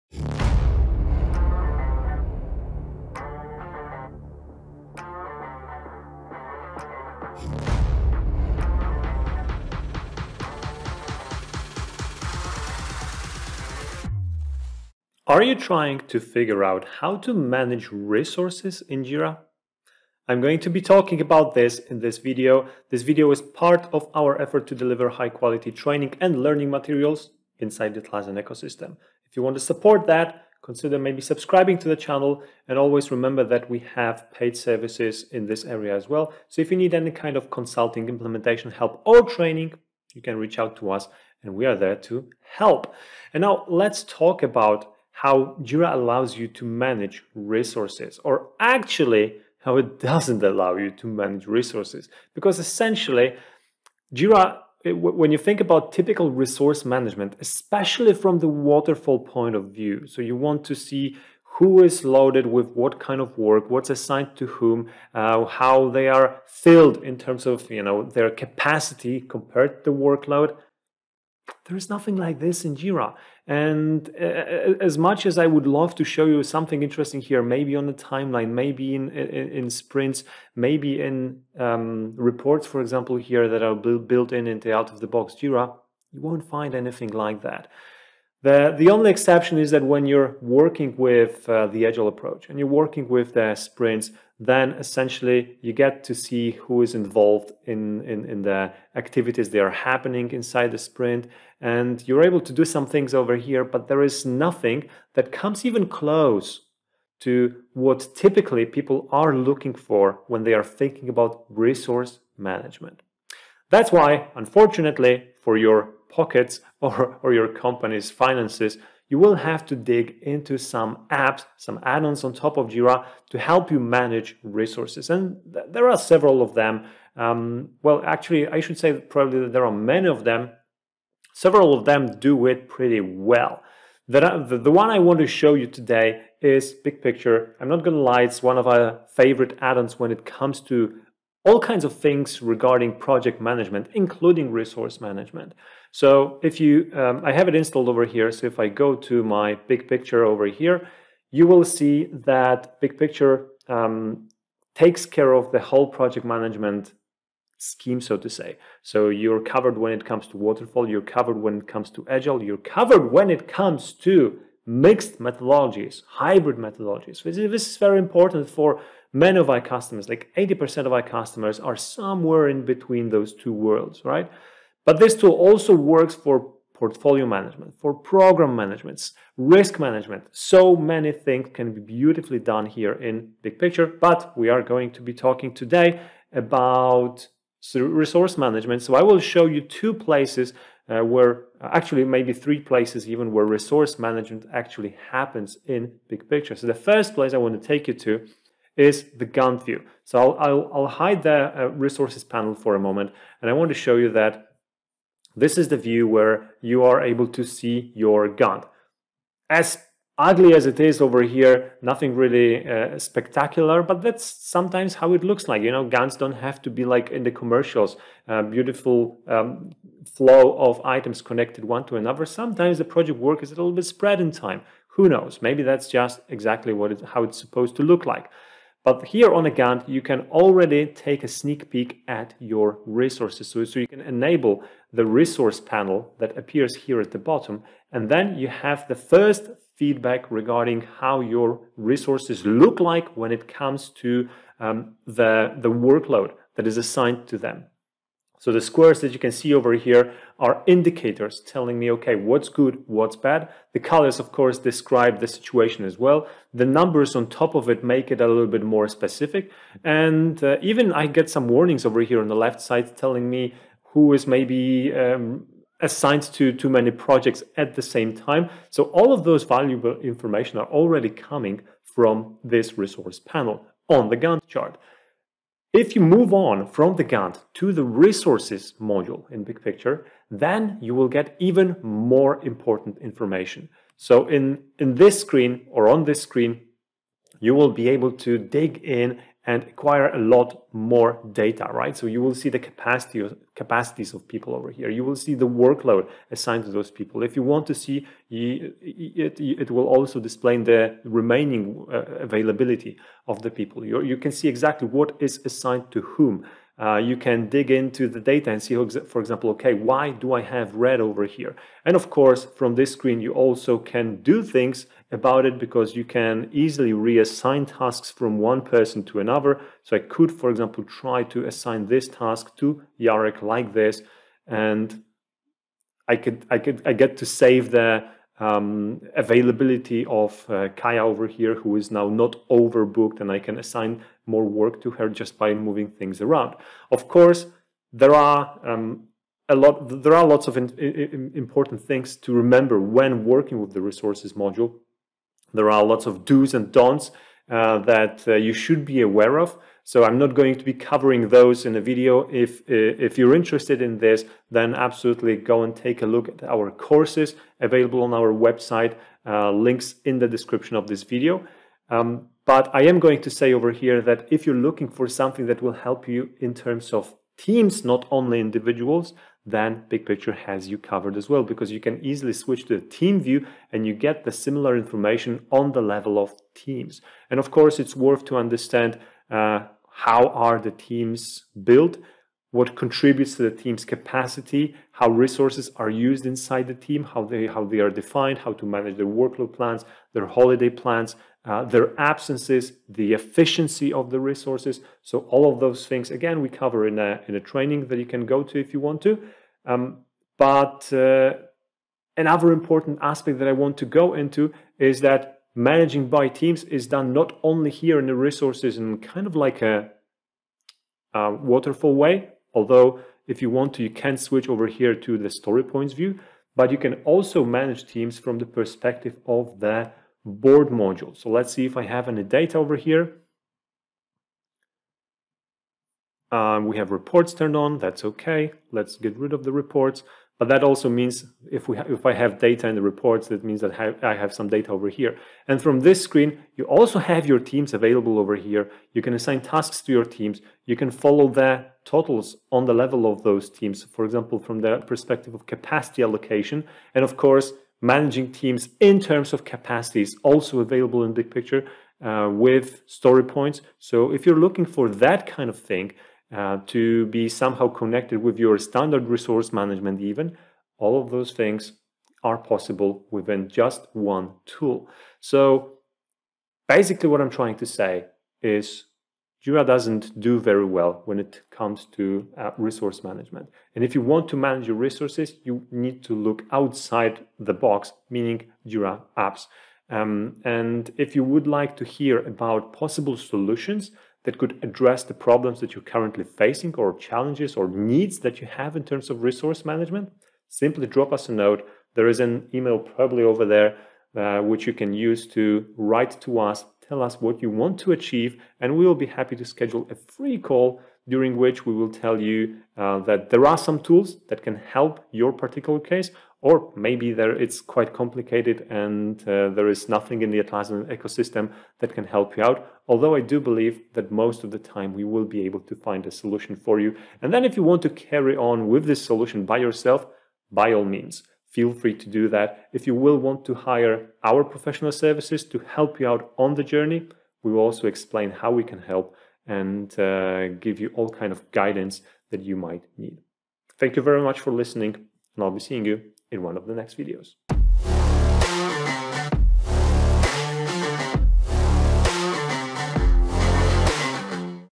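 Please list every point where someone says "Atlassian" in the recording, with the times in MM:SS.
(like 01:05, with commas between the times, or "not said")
00:28, 08:30.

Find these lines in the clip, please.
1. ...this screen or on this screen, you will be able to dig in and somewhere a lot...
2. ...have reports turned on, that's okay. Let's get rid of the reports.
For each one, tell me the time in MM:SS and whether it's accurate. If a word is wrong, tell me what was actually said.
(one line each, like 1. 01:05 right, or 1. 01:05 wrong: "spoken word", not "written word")
1. 04:44 wrong: "acquire", not "somewhere"
2. 07:06 right.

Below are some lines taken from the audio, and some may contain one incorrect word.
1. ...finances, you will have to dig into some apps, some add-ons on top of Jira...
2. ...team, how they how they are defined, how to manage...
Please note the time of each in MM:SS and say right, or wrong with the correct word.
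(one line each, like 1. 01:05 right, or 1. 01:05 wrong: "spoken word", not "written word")
1. 01:58 right
2. 06:26 right.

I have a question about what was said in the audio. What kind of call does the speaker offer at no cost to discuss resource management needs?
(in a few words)
free call.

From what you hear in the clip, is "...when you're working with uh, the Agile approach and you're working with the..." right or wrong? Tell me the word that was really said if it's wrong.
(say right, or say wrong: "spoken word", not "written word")
right.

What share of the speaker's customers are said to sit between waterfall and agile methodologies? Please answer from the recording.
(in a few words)
80%.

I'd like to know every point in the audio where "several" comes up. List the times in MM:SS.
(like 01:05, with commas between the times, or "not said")
02:06, 02:11.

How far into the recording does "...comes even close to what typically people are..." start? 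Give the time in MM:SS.
01:45.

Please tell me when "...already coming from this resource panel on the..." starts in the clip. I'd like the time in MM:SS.
04:30.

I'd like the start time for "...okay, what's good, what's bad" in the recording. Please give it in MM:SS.
04:11.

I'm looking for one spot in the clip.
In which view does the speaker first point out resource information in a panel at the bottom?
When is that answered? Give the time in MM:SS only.
03:19.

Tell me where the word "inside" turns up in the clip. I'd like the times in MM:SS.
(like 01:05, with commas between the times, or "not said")
00:27, 01:40, 06:26.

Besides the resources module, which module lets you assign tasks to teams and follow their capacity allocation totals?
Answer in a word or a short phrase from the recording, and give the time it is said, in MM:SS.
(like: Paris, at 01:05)
board module, at 07:00.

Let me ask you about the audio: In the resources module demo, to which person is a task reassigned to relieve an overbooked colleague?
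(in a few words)
Yarek.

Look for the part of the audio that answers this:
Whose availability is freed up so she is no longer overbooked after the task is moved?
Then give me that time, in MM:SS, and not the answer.
05:30.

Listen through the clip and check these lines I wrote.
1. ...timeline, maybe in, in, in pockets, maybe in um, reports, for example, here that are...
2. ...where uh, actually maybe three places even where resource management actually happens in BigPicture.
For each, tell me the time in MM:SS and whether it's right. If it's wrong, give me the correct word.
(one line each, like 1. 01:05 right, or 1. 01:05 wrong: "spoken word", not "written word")
1. 01:17 wrong: "sprints", not "pockets"
2. 03:11 right.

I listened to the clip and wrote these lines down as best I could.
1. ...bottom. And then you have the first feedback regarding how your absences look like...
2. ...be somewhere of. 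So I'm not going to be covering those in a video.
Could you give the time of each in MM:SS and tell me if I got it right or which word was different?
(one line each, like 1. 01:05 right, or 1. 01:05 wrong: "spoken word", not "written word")
1. 03:57 wrong: "resources", not "absences"
2. 05:48 wrong: "aware", not "somewhere".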